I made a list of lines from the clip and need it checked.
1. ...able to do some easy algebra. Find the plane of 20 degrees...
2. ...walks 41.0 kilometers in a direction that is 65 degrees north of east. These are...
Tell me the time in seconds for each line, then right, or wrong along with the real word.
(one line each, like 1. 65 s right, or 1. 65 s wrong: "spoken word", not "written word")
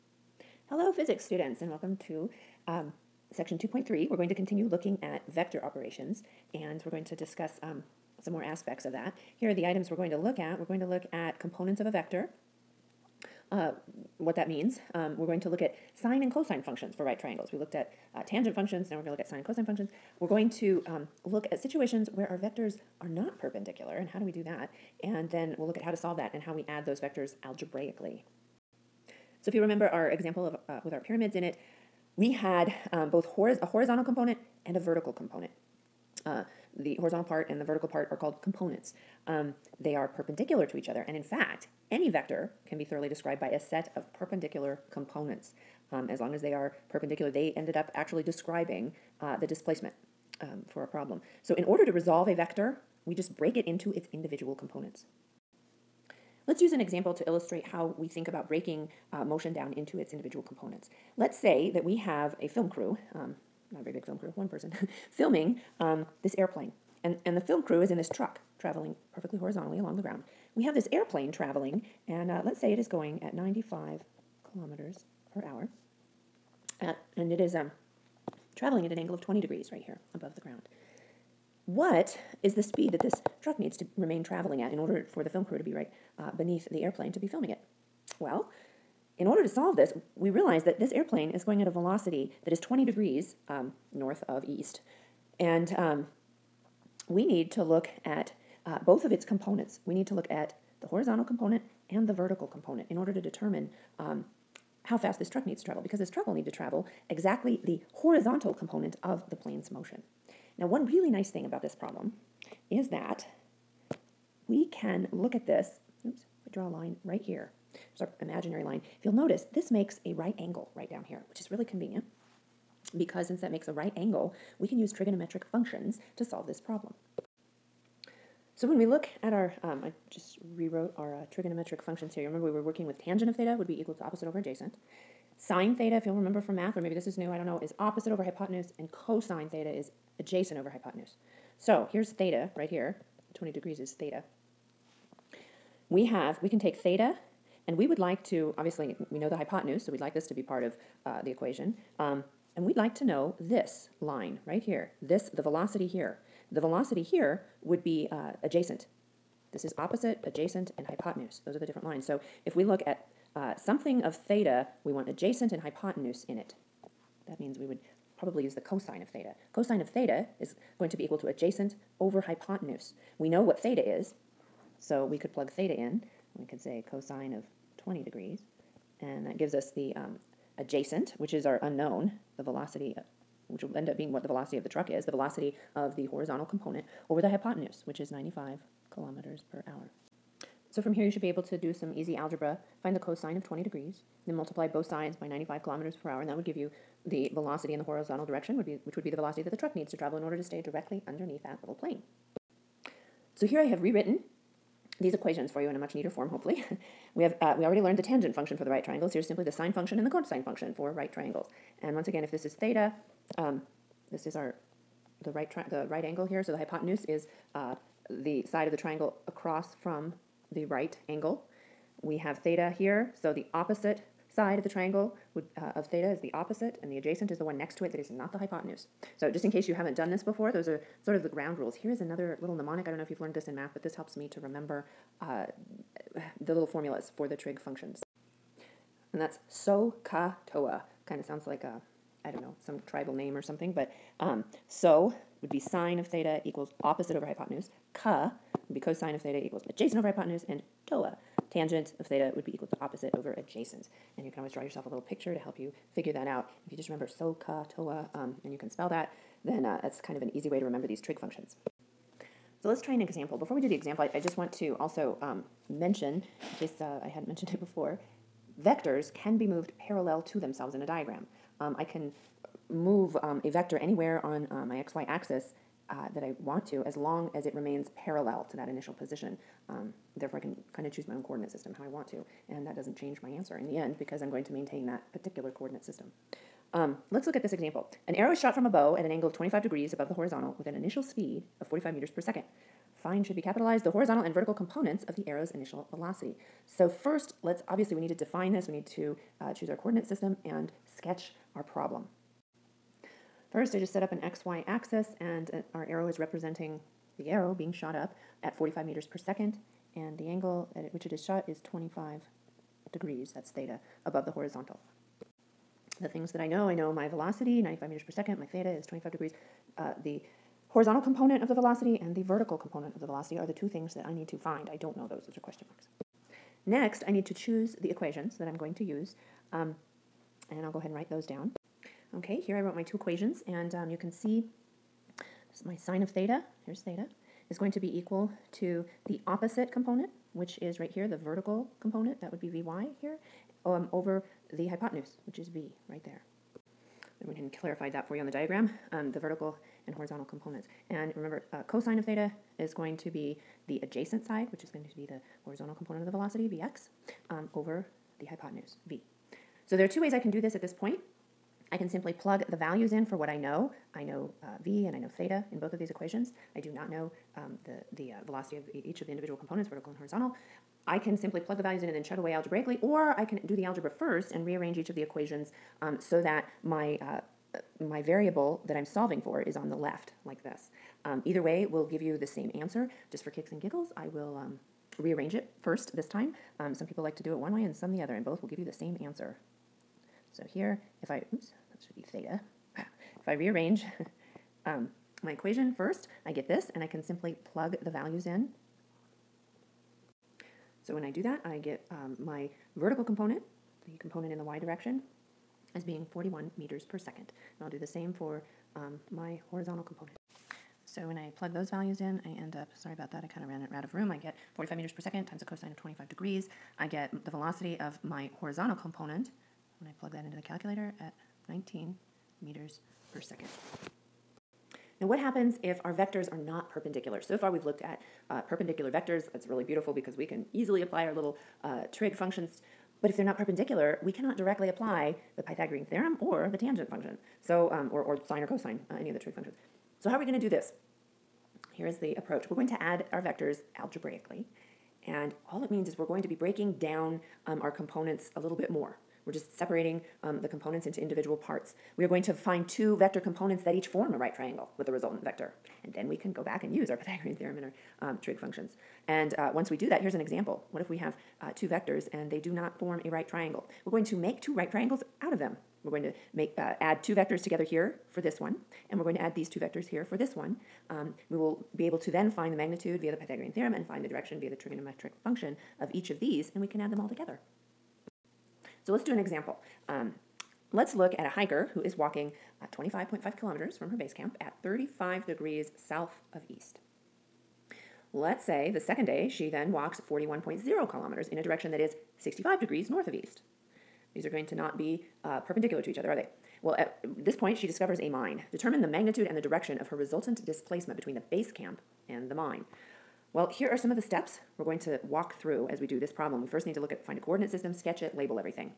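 1. 191 s wrong: "cosine", not "plane"
2. 489 s right.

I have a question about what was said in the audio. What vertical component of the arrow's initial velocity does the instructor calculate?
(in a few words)
41 meters per second.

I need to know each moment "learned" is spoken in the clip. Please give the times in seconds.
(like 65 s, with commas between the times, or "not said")
207 s, 233 s.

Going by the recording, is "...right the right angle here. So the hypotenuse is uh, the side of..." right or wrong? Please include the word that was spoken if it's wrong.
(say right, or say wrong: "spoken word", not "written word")
right.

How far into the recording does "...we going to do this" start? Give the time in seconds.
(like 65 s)
440 s.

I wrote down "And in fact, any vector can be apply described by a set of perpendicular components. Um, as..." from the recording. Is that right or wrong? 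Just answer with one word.
wrong.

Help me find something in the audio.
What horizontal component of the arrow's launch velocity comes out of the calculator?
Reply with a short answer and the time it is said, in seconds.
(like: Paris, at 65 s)
19 meters per second, at 421 s.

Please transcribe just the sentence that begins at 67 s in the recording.
And, and the film crew is in this truck traveling perfectly horizontally along the ground.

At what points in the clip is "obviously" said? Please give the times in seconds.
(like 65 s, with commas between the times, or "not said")
148 s, 297 s.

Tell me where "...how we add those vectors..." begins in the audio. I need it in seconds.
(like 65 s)
26 s.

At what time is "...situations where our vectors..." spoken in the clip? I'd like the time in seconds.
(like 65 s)
21 s.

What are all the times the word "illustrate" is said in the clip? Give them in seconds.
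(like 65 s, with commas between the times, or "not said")
57 s.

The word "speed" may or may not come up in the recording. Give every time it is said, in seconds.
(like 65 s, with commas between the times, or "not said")
82 s, 291 s.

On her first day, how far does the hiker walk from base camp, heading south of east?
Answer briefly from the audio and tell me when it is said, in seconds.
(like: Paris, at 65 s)
25.5 kilometers, at 482 s.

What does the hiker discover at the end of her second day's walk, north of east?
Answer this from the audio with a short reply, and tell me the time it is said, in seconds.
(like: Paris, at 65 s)
a mine, at 497 s.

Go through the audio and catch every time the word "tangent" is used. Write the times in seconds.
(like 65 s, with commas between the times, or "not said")
18 s, 132 s, 208 s, 251 s, 436 s.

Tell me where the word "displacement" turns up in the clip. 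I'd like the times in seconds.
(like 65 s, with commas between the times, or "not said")
49 s, 500 s.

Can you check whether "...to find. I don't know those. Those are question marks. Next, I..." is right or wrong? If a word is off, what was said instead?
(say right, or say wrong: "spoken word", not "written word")
right.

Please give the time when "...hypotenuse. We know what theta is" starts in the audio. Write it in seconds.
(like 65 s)
172 s.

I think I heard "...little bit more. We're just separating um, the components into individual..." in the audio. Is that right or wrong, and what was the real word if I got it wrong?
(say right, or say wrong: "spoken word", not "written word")
right.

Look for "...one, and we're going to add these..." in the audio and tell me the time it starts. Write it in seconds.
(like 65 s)
468 s.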